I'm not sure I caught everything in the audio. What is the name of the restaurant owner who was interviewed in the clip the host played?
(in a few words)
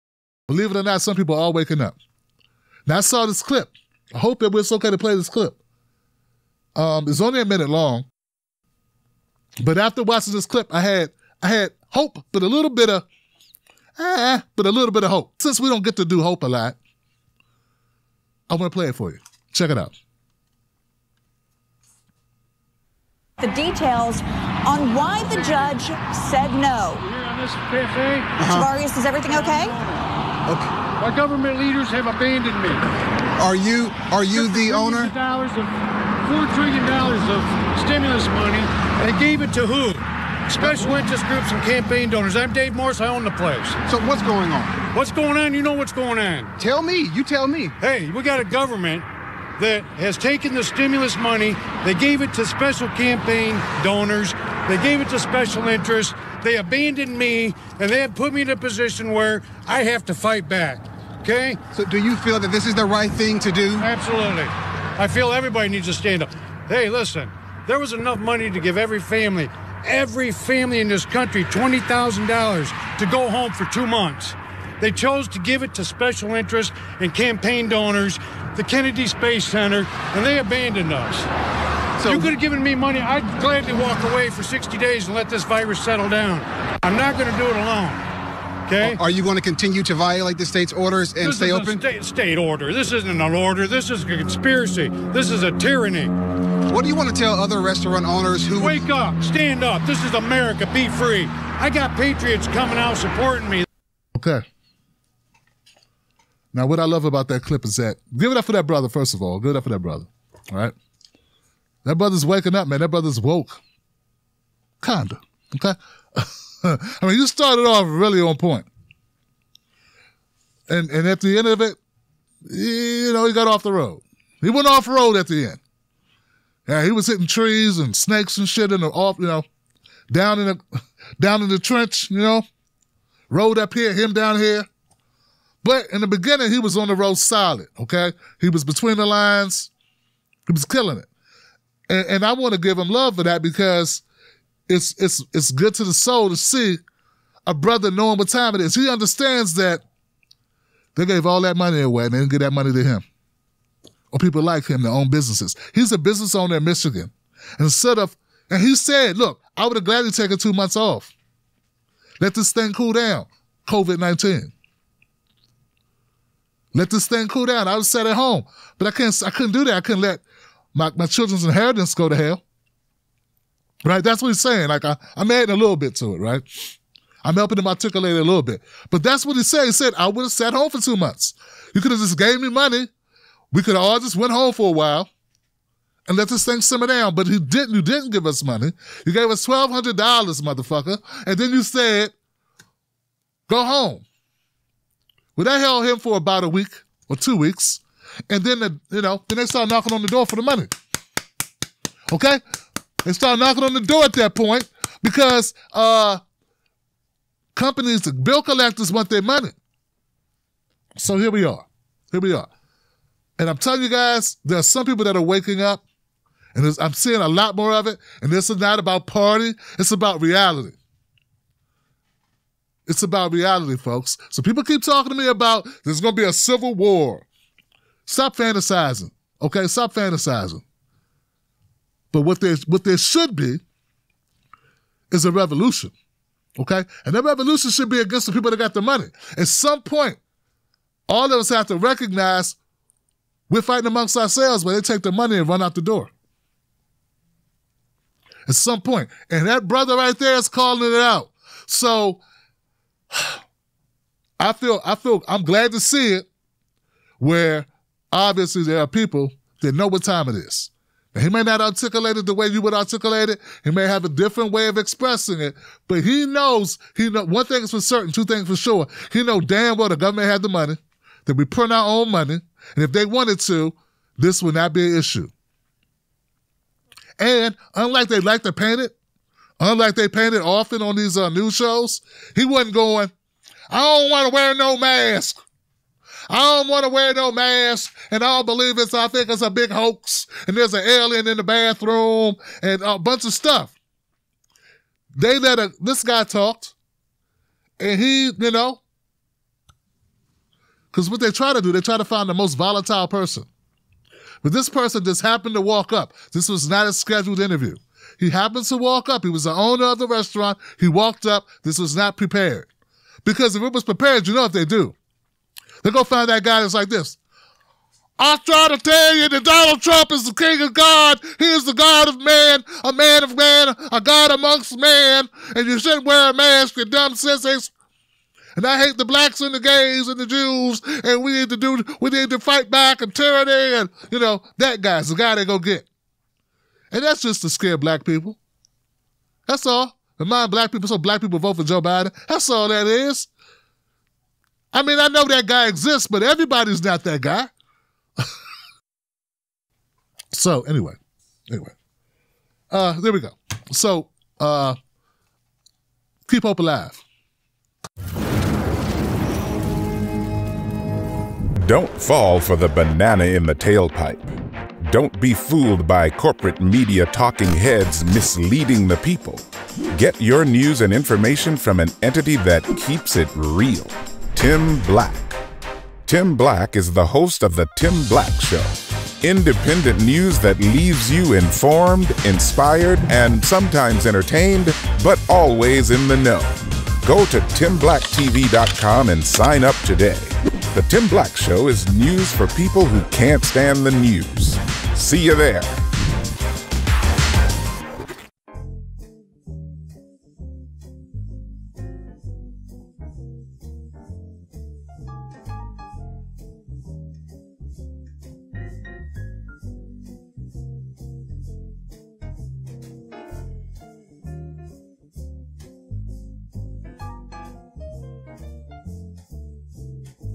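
Dave Morris.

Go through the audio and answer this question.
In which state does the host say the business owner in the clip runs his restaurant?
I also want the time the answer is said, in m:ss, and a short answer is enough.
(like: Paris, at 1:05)
Michigan, at 2:36.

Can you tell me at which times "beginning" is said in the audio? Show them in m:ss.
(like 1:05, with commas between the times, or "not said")
2:16.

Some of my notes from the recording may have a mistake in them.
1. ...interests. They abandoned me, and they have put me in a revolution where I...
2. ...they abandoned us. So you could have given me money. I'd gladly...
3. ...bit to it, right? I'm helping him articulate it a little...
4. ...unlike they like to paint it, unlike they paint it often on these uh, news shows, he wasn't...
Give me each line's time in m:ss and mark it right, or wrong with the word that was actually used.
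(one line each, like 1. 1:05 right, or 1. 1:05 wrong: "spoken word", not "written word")
1. 0:55 wrong: "position", not "revolution"
2. 1:20 right
3. 2:55 right
4. 4:37 right.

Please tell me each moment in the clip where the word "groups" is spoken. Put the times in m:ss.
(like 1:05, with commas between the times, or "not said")
0:41.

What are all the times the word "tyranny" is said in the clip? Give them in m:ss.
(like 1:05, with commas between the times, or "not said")
1:35, 5:33.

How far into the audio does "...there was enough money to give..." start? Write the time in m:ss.
1:07.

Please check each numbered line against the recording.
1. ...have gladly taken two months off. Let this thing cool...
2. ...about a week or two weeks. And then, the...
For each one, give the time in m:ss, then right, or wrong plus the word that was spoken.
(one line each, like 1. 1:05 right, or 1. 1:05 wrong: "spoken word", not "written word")
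1. 2:39 right
2. 3:16 right.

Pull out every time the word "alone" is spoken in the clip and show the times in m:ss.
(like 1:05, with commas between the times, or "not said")
1:27.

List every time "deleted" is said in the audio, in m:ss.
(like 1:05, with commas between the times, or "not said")
not said.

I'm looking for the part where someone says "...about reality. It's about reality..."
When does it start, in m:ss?
3:39.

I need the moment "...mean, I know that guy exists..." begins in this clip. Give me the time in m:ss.
5:44.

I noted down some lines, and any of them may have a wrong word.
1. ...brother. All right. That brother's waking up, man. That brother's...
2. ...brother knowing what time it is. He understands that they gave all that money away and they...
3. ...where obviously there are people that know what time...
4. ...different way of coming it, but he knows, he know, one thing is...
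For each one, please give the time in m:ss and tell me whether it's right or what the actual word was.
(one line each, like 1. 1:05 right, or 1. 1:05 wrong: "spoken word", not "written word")
1. 1:49 right
2. 2:27 right
3. 4:17 right
4. 4:24 wrong: "expressing", not "coming".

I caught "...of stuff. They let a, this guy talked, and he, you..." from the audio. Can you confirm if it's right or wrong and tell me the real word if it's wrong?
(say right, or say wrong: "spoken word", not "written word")
right.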